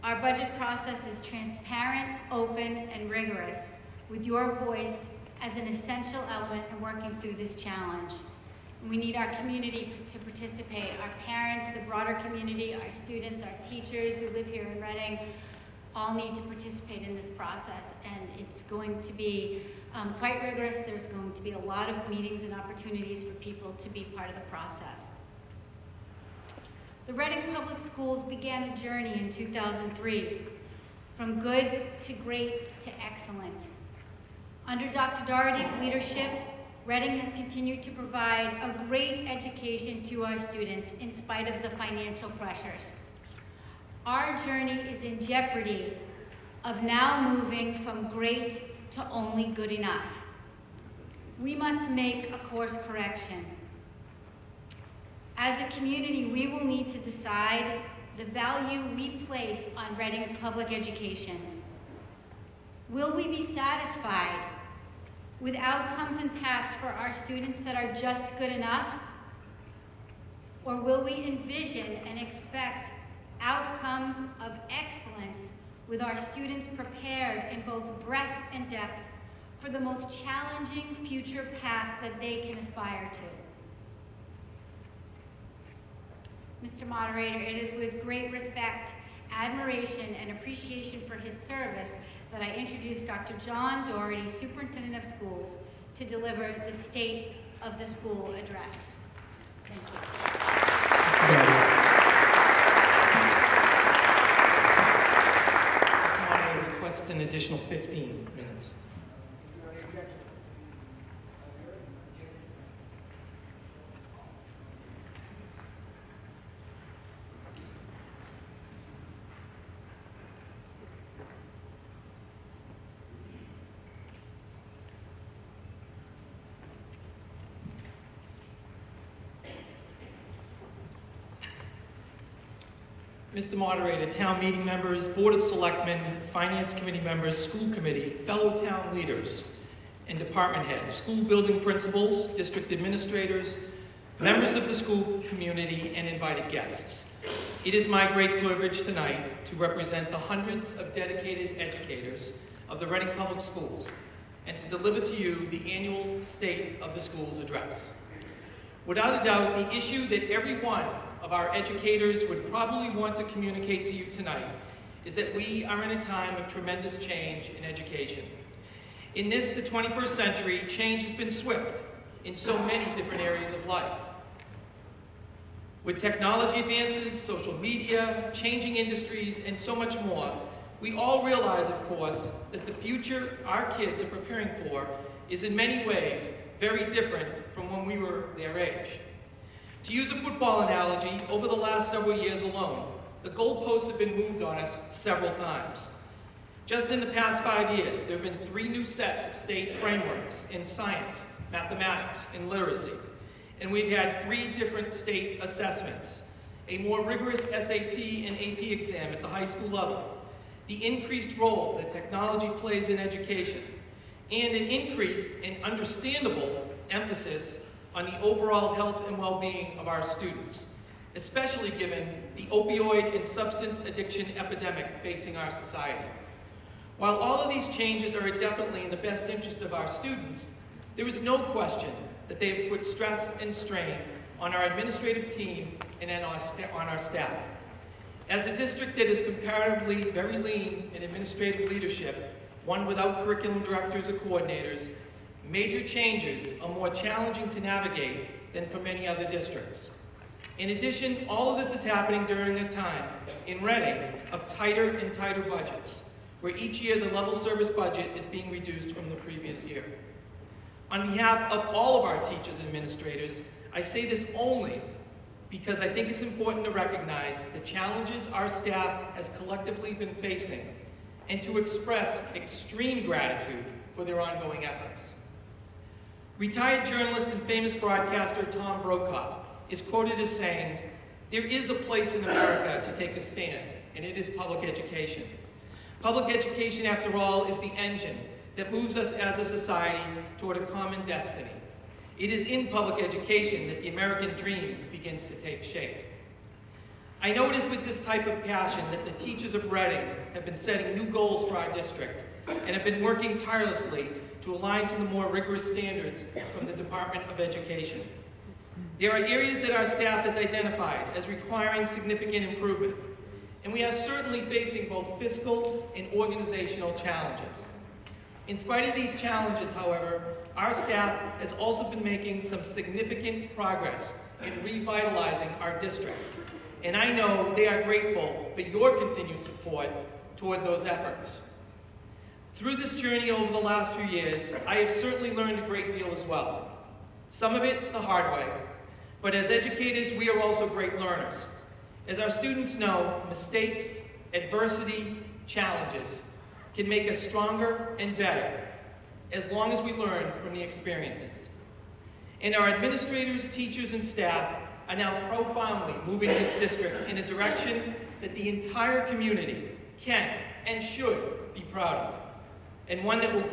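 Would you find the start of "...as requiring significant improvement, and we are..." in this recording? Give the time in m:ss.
5:11.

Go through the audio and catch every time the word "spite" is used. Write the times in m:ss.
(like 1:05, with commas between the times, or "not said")
0:41, 5:18.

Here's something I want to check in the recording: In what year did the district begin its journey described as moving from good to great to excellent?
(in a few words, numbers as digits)
2003.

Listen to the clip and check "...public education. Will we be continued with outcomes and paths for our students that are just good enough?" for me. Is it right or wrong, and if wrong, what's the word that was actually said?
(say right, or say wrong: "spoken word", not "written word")
wrong: "satisfied", not "continued".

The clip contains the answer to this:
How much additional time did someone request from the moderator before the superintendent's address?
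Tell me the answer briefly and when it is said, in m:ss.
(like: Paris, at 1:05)
15 minutes, at 1:47.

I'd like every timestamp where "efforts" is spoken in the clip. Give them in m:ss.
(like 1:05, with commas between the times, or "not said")
4:34, 5:30.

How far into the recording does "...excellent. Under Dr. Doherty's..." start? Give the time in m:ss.
0:33.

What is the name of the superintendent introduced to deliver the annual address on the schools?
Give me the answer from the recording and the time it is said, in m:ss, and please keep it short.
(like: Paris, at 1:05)
John Doherty, at 1:33.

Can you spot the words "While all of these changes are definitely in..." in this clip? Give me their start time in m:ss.
3:46.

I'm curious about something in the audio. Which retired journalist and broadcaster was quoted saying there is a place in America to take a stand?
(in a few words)
Tom Brokaw.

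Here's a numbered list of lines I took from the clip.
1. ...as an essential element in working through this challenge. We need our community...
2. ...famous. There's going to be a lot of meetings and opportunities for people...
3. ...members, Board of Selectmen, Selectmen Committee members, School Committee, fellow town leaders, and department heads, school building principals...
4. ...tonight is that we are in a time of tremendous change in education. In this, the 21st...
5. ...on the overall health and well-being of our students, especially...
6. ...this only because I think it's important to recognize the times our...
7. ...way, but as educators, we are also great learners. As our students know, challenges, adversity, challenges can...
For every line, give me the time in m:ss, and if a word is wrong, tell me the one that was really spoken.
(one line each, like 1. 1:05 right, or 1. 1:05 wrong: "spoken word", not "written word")
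1. 0:05 right
2. 0:20 wrong: "rigorous", not "famous"
3. 2:14 wrong: "Finance", not "Selectmen"
4. 2:44 right
5. 3:37 right
6. 4:24 wrong: "challenges", not "times"
7. 5:38 wrong: "mistakes", not "challenges".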